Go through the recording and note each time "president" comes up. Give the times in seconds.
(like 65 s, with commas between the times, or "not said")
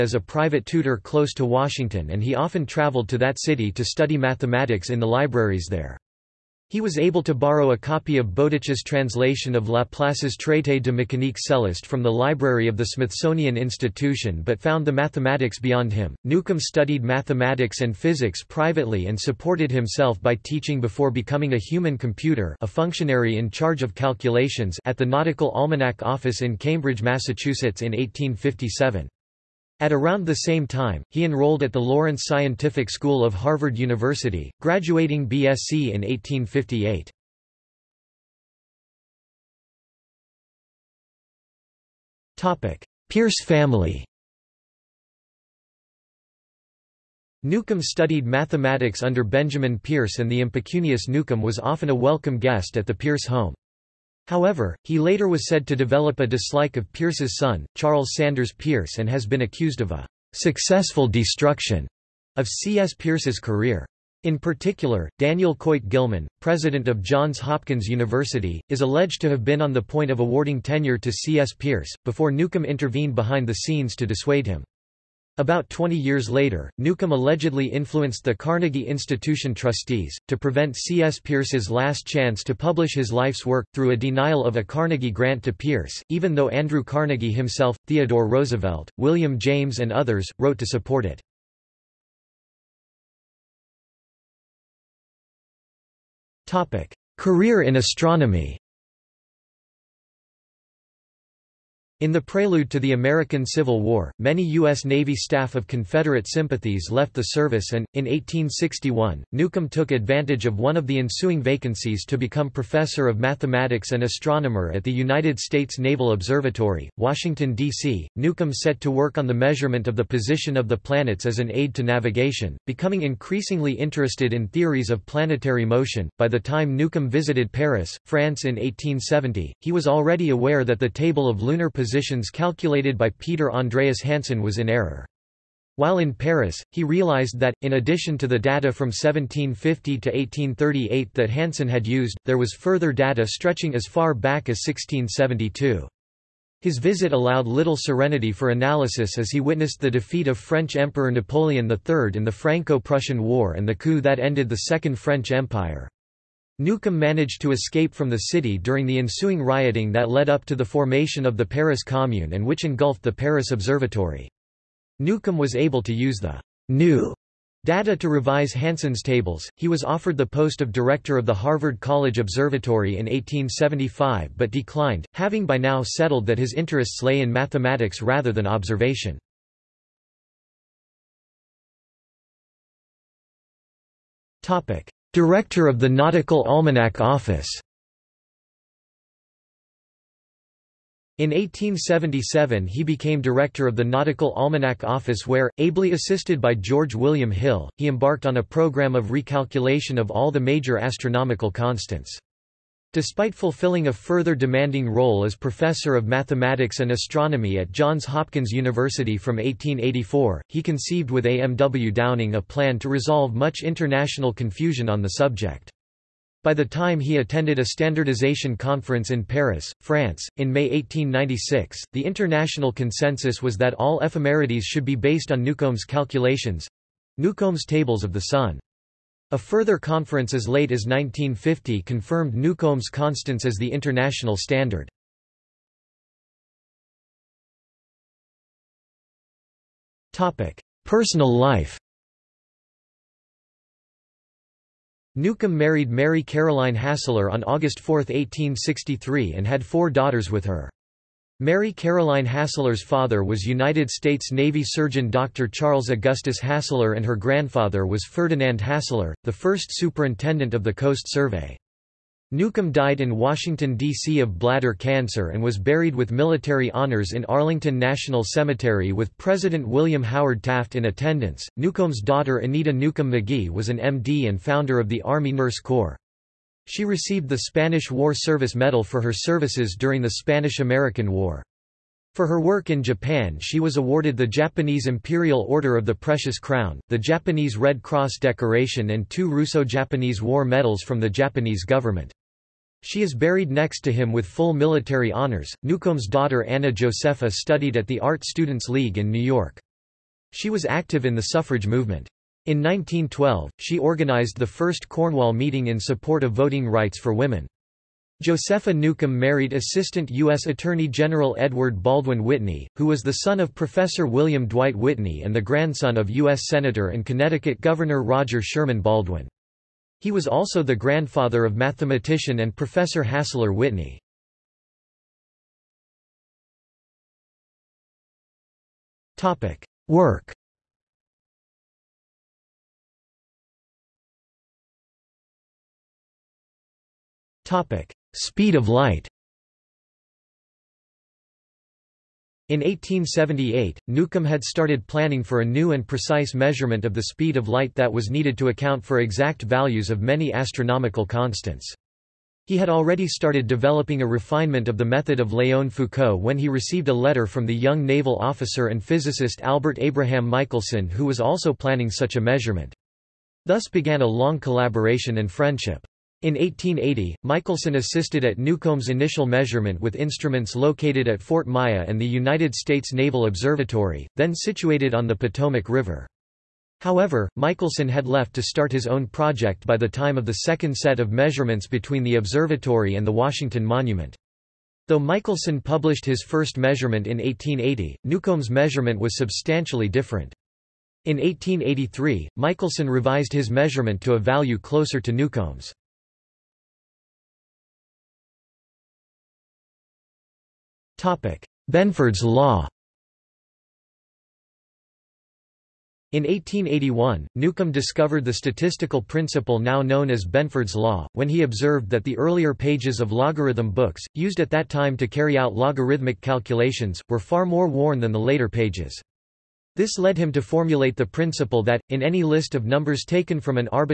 66 s, 269 s.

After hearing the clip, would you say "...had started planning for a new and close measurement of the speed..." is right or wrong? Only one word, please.
wrong.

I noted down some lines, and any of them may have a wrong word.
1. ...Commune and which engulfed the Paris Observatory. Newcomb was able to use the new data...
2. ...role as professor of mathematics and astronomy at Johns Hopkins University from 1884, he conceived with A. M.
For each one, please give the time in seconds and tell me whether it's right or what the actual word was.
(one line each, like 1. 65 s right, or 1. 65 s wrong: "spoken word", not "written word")
1. 161 s right
2. 204 s right.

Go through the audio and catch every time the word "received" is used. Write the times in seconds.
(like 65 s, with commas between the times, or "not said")
276 s, 356 s.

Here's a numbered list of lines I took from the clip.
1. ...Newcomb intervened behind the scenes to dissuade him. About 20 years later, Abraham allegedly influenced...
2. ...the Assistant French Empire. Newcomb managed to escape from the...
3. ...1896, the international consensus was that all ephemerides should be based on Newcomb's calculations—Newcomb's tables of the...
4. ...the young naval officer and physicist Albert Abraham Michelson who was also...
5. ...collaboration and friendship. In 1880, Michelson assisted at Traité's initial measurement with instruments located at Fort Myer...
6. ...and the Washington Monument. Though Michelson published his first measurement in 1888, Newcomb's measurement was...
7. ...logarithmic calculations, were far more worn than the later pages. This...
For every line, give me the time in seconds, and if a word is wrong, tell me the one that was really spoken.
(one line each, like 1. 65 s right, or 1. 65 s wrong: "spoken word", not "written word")
1. 72 s wrong: "Newcomb", not "Abraham"
2. 154 s wrong: "Second", not "Assistant"
3. 220 s right
4. 357 s right
5. 364 s wrong: "Newcomb", not "Traité"
6. 382 s wrong: "1880", not "1888"
7. 415 s right.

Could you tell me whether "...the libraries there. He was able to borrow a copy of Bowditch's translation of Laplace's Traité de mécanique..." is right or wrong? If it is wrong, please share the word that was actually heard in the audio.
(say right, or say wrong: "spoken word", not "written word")
right.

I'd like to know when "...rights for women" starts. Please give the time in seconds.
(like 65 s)
306 s.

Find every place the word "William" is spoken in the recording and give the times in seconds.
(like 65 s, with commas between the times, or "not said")
88 s, 196 s, 269 s, 314 s.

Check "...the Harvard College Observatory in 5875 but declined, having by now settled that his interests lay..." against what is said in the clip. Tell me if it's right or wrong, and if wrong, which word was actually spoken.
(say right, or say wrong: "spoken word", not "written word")
wrong: "1875", not "5875".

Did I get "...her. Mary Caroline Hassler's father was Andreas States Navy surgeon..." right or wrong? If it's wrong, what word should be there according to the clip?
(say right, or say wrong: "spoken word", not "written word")
wrong: "United", not "Andreas".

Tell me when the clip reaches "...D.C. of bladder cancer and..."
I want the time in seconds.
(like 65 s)
263 s.